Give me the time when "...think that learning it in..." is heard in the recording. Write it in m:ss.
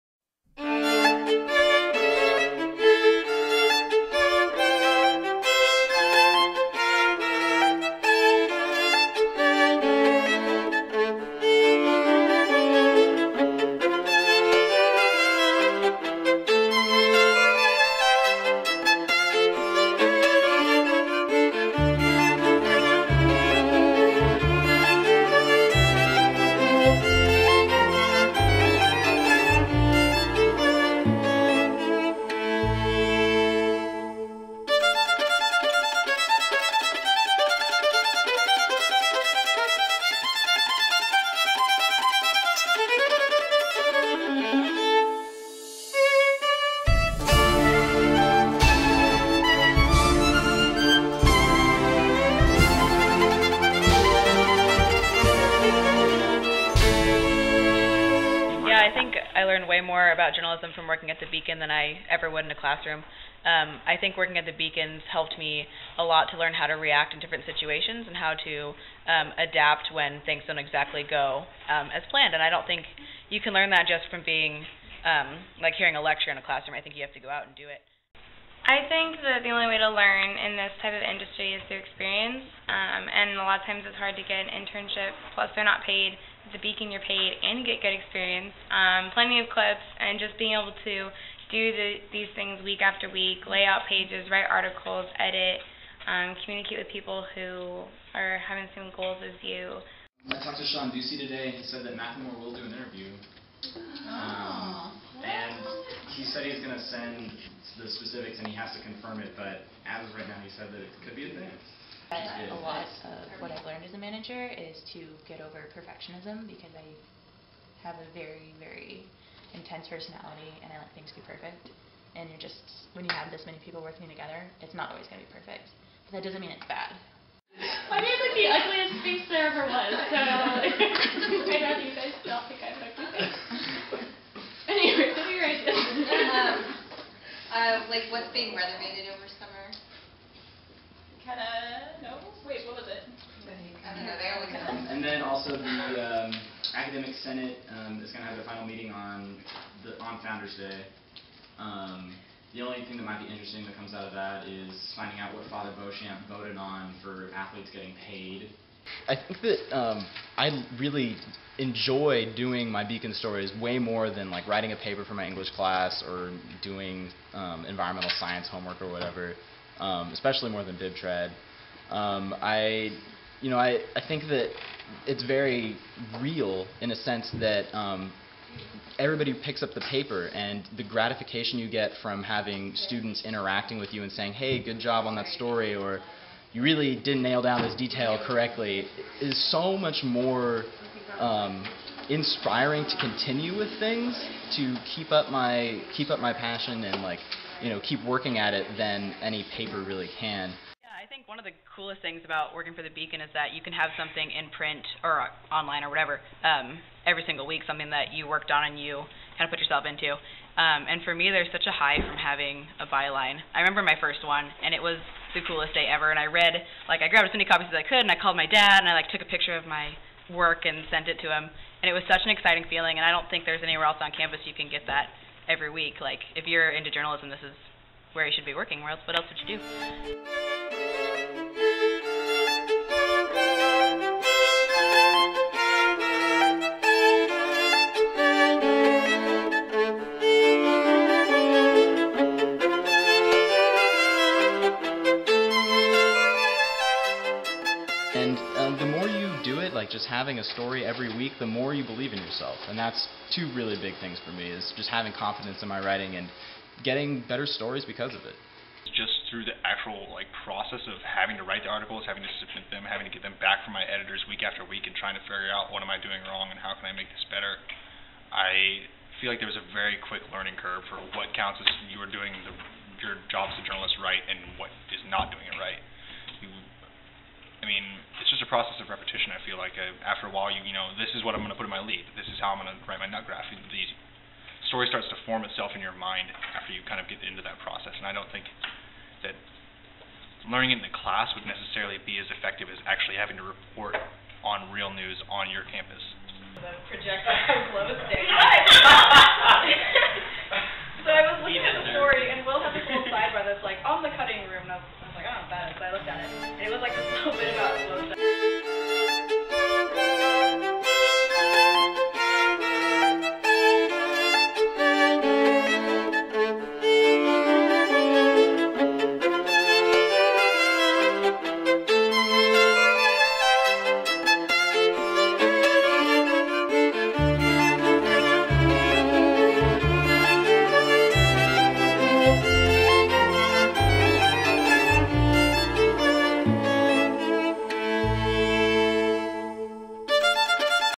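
4:48.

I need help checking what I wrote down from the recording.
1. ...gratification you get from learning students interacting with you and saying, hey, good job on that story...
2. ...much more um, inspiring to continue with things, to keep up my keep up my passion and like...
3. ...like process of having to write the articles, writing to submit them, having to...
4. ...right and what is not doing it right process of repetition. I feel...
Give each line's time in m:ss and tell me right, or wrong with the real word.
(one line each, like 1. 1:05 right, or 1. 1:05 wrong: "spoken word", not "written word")
1. 3:00 wrong: "having", not "learning"
2. 3:09 right
3. 4:20 wrong: "having", not "writing"
4. 4:34 right.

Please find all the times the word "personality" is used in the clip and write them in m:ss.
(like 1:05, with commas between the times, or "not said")
1:59.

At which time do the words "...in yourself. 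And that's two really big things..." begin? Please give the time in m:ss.
4:12.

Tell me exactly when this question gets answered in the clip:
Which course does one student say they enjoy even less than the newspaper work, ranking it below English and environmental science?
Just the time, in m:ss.
2:50.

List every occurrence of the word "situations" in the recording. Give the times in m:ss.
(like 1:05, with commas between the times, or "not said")
1:07.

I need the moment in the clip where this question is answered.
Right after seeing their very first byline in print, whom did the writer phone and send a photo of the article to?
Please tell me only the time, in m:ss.
3:38.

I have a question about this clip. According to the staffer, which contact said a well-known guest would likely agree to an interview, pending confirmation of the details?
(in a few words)
Sean Ducey.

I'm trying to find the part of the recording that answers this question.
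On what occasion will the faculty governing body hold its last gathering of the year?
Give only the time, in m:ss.
2:30.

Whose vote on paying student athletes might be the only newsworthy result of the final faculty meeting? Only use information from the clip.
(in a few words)
Father Beauchamp.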